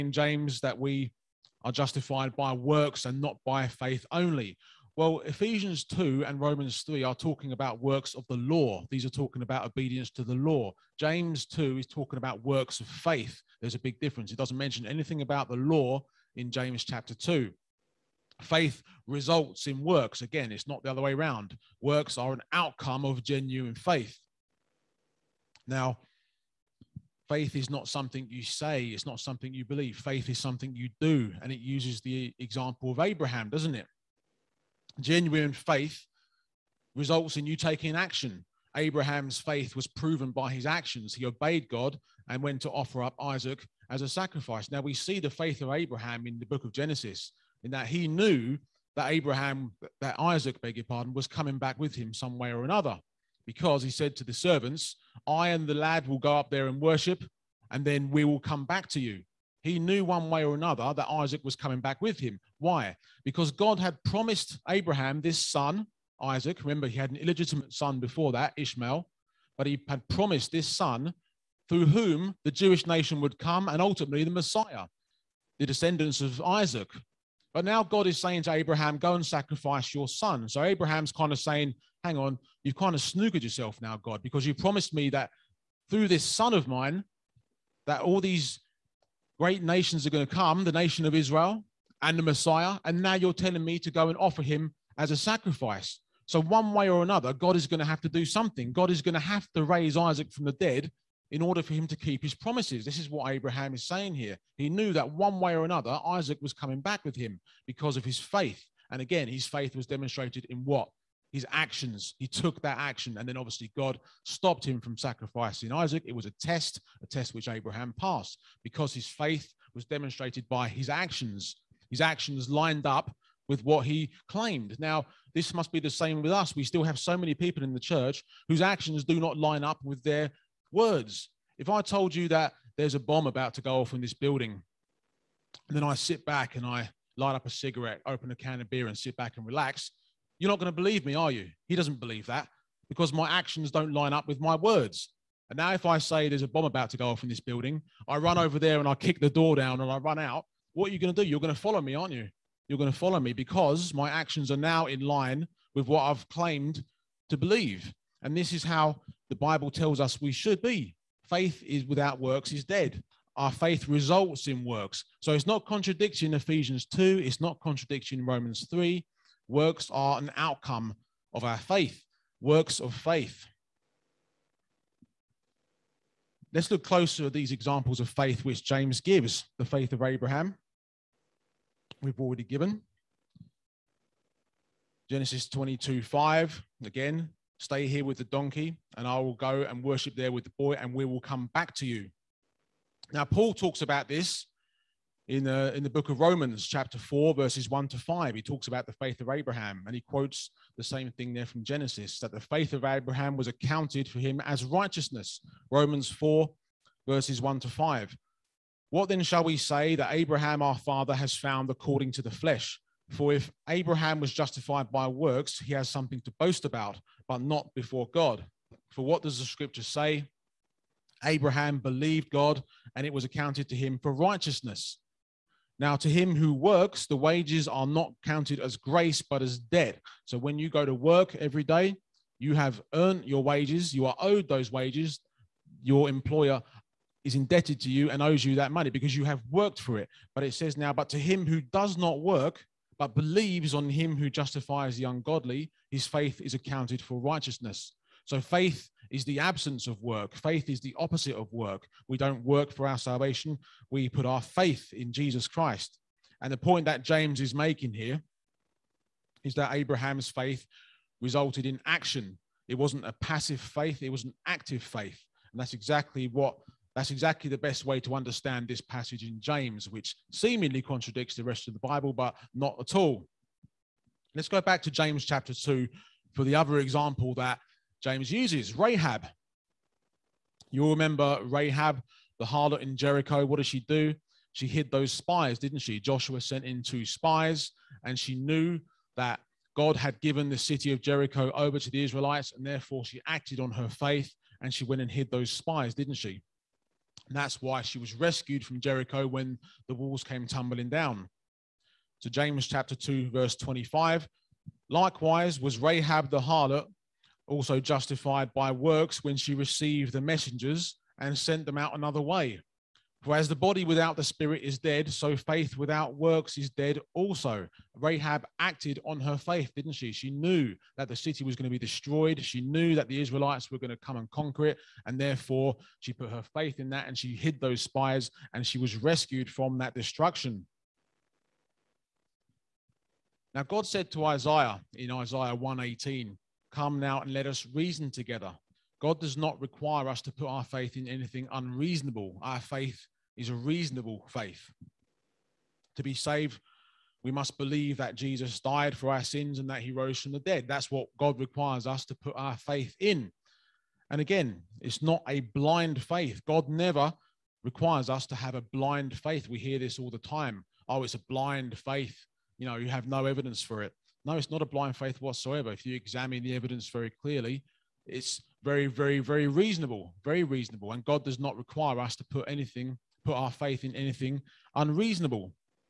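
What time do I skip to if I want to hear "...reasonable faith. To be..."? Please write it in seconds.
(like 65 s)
343 s.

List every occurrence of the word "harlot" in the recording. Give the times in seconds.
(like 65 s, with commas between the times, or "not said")
282 s, 306 s.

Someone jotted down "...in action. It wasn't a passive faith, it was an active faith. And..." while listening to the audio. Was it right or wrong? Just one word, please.
right.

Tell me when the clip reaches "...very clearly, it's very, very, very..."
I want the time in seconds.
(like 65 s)
366 s.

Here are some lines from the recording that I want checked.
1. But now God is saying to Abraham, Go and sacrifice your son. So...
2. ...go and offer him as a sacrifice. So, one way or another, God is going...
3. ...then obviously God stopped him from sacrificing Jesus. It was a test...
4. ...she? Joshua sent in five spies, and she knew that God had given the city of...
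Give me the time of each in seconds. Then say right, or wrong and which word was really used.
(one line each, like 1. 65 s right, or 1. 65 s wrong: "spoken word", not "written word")
1. 77 s right
2. 93 s right
3. 113 s wrong: "Isaac", not "Jesus"
4. 285 s wrong: "two", not "five".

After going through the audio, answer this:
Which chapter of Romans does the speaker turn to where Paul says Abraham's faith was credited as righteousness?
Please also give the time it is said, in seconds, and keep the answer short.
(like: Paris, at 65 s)
Chapter 4, at 196 s.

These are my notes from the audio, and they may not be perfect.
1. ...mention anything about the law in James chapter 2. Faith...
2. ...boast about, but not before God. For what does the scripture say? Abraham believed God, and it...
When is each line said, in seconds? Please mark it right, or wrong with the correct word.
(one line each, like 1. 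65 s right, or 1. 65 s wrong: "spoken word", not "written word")
1. 14 s right
2. 216 s right.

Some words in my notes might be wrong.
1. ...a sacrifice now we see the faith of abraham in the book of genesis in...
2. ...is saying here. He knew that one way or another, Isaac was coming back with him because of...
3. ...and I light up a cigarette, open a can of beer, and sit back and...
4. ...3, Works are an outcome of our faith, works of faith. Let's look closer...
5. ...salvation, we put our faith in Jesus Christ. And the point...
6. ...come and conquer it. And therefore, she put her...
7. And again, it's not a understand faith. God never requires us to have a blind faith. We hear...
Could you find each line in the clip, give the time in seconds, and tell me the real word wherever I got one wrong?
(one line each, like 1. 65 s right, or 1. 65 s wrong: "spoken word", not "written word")
1. 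44 s right
2. 103 s right
3. 136 s right
4. 168 s right
5. 252 s right
6. 323 s right
7. 354 s wrong: "blind", not "understand".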